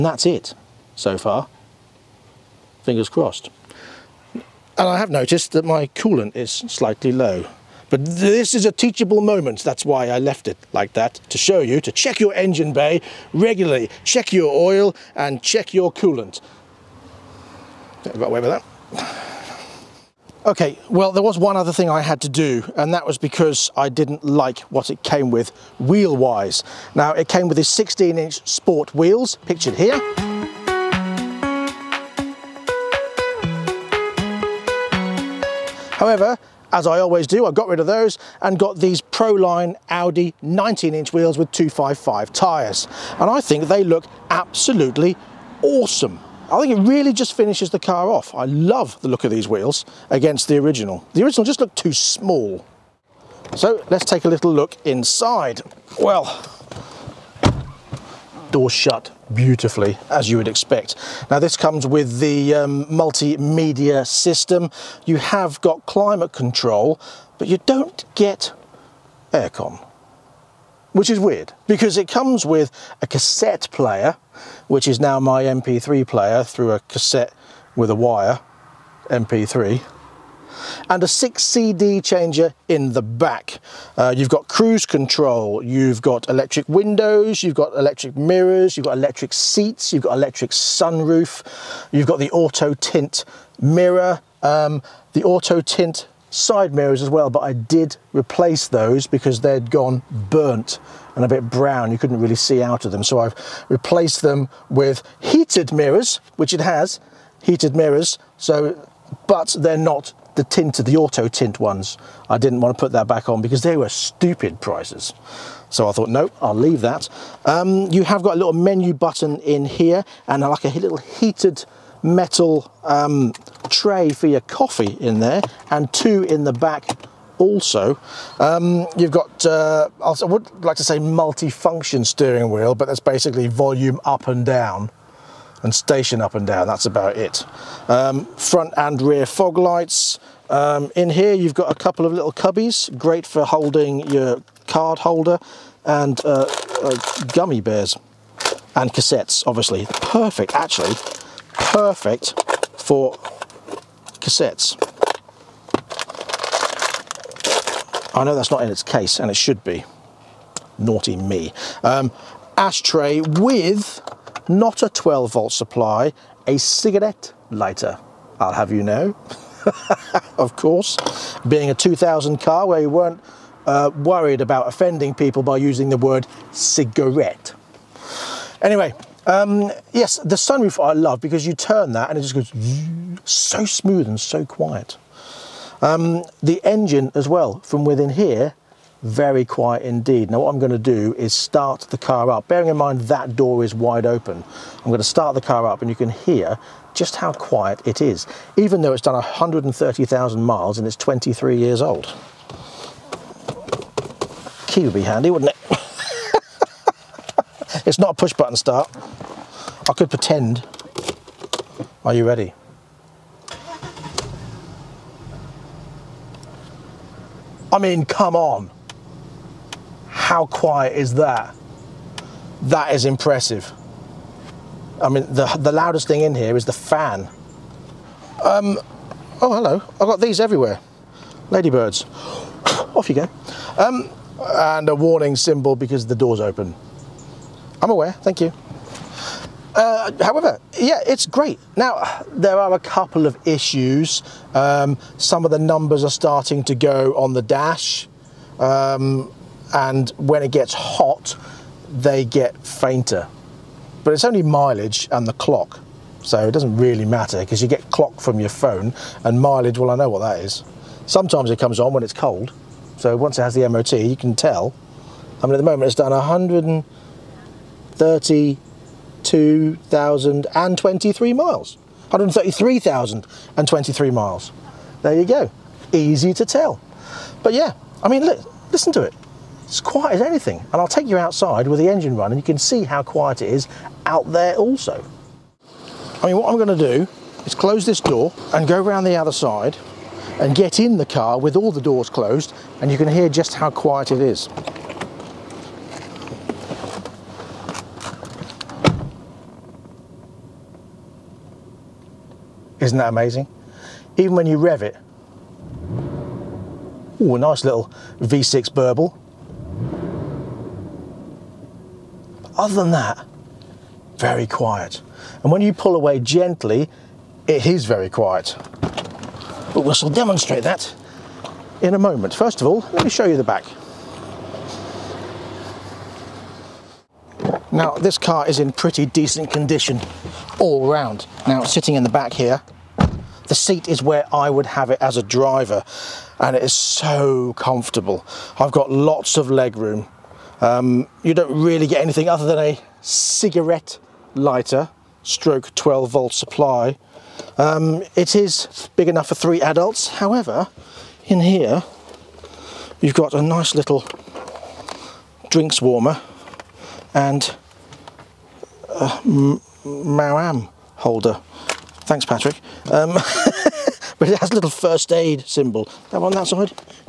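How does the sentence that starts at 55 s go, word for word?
Well, door shut beautifully as you would expect.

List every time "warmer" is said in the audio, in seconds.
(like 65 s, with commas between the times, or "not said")
355 s.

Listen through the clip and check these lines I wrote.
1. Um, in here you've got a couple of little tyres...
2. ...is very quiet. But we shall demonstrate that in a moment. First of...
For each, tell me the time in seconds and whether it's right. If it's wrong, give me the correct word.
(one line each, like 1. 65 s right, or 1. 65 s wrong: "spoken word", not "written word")
1. 140 s wrong: "cubbies", not "tyres"
2. 317 s right.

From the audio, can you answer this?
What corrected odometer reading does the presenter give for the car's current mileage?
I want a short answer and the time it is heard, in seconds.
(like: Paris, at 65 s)
133,023 miles, at 272 s.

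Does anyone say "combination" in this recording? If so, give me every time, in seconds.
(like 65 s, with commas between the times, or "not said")
not said.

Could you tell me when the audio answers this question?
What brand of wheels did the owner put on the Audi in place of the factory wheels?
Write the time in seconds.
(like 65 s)
39 s.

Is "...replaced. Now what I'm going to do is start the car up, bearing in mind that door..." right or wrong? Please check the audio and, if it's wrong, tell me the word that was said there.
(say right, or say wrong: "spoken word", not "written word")
wrong: "indeed", not "replaced".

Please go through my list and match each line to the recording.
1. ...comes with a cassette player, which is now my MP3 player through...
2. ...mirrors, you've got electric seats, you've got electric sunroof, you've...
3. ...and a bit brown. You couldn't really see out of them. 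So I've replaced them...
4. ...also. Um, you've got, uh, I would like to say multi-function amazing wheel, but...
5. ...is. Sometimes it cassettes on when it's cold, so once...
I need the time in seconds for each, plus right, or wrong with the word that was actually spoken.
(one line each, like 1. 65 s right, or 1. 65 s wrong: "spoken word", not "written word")
1. 72 s right
2. 88 s right
3. 101 s right
4. 127 s wrong: "steering", not "amazing"
5. 260 s wrong: "comes", not "cassettes".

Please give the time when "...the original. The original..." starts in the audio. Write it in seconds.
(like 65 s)
50 s.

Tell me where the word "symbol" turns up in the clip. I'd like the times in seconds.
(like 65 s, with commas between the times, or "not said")
235 s, 365 s.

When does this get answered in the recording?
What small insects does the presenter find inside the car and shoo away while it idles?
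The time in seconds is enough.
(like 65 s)
231 s.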